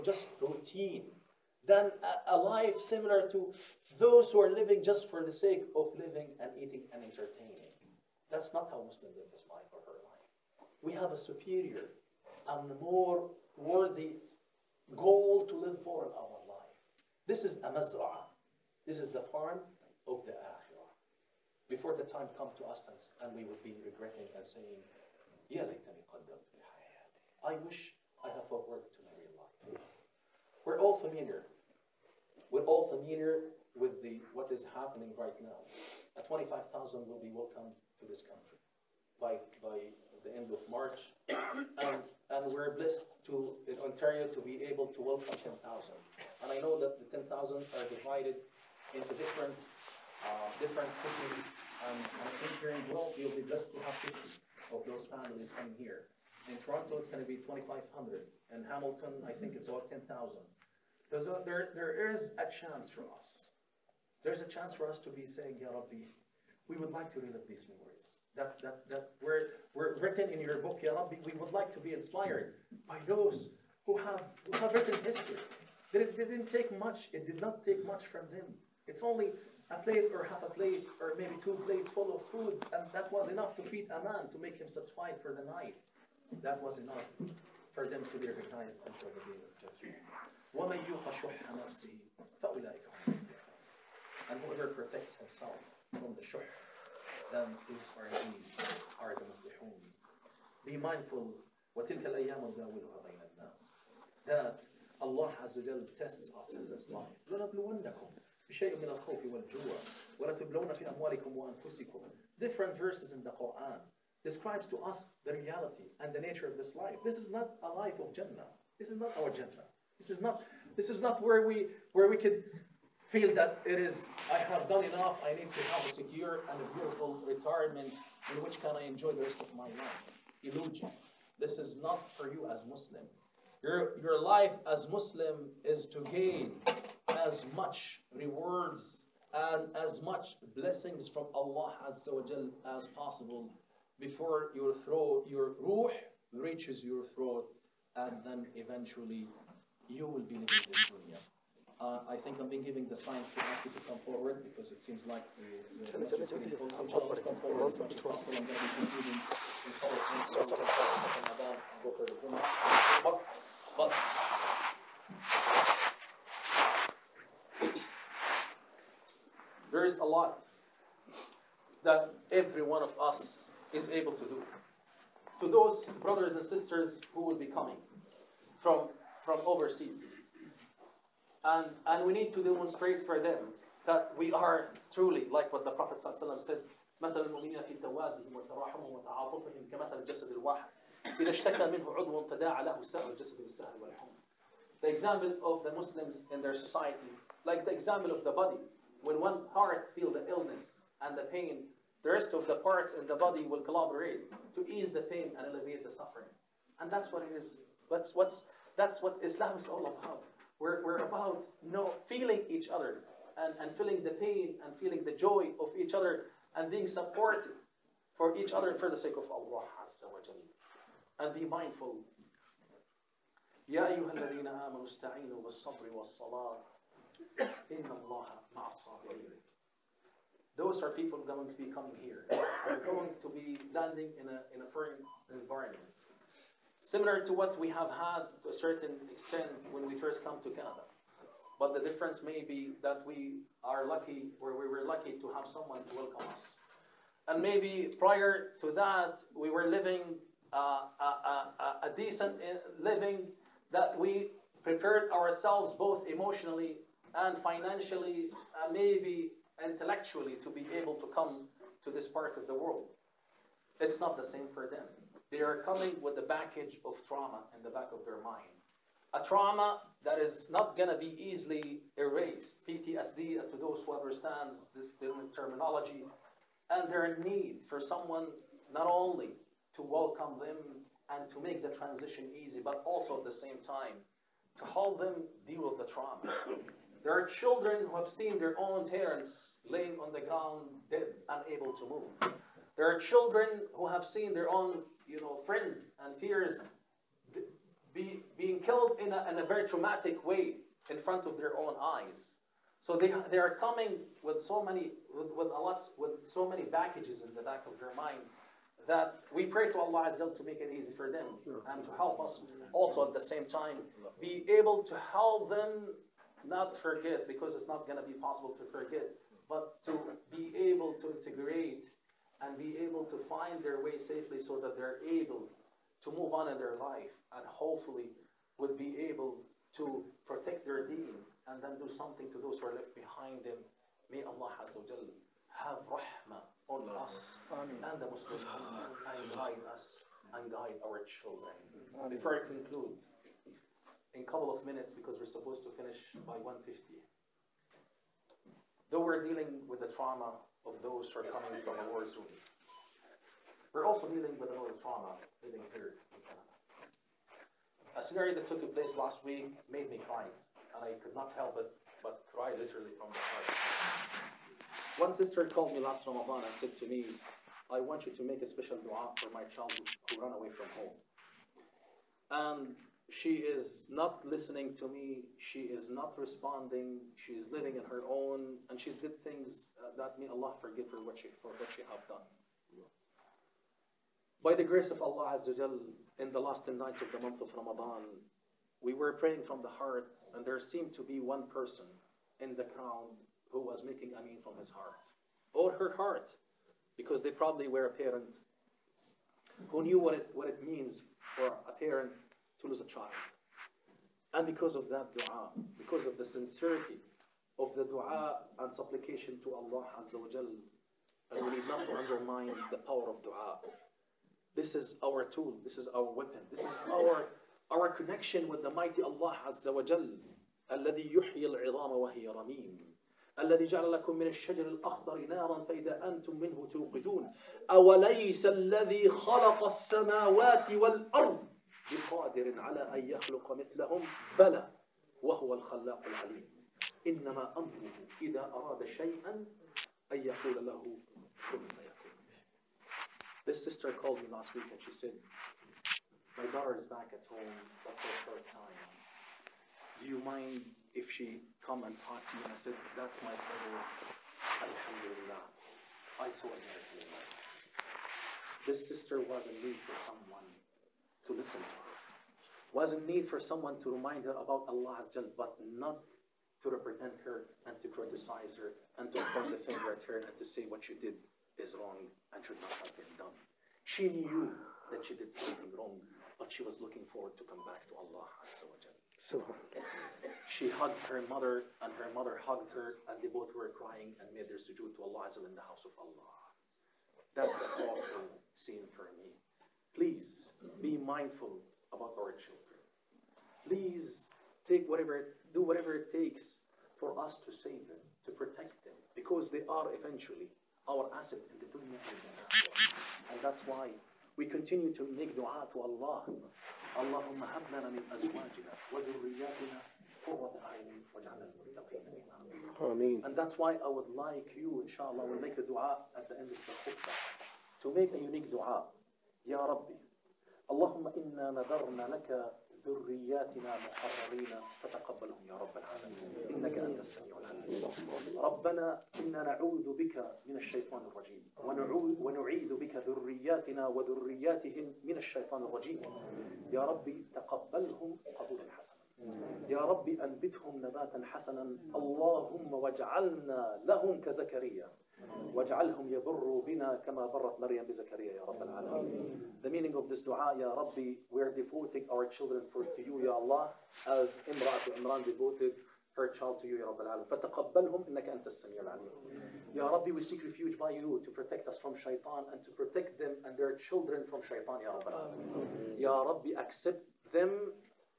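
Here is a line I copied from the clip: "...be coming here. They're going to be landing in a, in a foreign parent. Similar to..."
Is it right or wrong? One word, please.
wrong.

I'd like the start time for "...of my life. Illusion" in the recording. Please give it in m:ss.
2:09.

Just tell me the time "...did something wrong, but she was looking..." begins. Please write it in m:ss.
7:55.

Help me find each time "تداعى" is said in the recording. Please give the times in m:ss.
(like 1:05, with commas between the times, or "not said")
3:12.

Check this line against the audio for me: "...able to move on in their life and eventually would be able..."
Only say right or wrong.
wrong.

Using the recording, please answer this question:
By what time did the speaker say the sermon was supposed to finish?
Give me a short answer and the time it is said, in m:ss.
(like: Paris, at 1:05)
1:50, at 5:46.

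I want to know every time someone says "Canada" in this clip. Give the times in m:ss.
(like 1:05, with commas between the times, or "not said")
4:00, 5:56.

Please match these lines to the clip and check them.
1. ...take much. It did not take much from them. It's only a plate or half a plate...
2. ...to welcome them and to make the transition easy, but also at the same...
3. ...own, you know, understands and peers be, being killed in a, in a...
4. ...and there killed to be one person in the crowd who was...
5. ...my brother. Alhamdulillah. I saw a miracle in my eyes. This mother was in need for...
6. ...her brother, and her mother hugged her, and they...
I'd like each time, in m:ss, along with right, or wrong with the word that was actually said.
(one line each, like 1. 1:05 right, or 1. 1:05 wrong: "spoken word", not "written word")
1. 1:16 right
2. 4:39 right
3. 4:54 wrong: "friends", not "understands"
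4. 6:30 wrong: "seemed", not "killed"
5. 7:33 wrong: "sister", not "mother"
6. 8:01 wrong: "mother", not "brother".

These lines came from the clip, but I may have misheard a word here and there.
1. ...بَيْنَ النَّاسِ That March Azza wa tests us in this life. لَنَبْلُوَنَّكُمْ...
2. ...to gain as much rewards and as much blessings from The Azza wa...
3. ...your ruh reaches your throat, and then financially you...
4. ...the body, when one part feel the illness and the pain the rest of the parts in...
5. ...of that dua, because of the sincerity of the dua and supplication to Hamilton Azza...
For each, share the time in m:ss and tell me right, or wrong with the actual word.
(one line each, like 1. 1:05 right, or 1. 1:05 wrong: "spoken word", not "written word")
1. 1:43 wrong: "Allah", not "March"
2. 2:15 wrong: "Allah", not "The"
3. 2:25 wrong: "eventually", not "financially"
4. 3:18 right
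5. 6:44 wrong: "Allah", not "Hamilton".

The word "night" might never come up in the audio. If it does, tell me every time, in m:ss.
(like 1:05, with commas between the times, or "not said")
1:25, 6:26.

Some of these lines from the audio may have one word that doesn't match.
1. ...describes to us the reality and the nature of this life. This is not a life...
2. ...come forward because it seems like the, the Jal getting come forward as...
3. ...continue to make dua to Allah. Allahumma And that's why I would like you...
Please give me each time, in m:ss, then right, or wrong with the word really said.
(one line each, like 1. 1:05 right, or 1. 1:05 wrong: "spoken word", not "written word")
1. 1:54 right
2. 2:33 wrong: "Muslims", not "Jal"
3. 8:24 right.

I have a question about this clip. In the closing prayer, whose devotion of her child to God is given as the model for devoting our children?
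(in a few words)
Imra'at Imran.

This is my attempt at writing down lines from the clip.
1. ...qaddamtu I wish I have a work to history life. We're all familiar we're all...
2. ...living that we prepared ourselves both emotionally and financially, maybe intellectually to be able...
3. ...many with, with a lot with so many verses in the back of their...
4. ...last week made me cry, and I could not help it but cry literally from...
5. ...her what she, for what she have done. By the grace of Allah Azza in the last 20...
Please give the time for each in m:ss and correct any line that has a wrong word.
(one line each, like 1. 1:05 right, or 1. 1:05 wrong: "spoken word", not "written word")
1. 0:26 wrong: "marry", not "history"
2. 4:12 right
3. 5:04 wrong: "packages", not "verses"
4. 5:58 right
5. 6:20 wrong: "10", not "20".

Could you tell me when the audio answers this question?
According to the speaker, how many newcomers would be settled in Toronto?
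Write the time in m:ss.
0:57.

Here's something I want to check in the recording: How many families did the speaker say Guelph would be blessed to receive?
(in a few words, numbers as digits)
50.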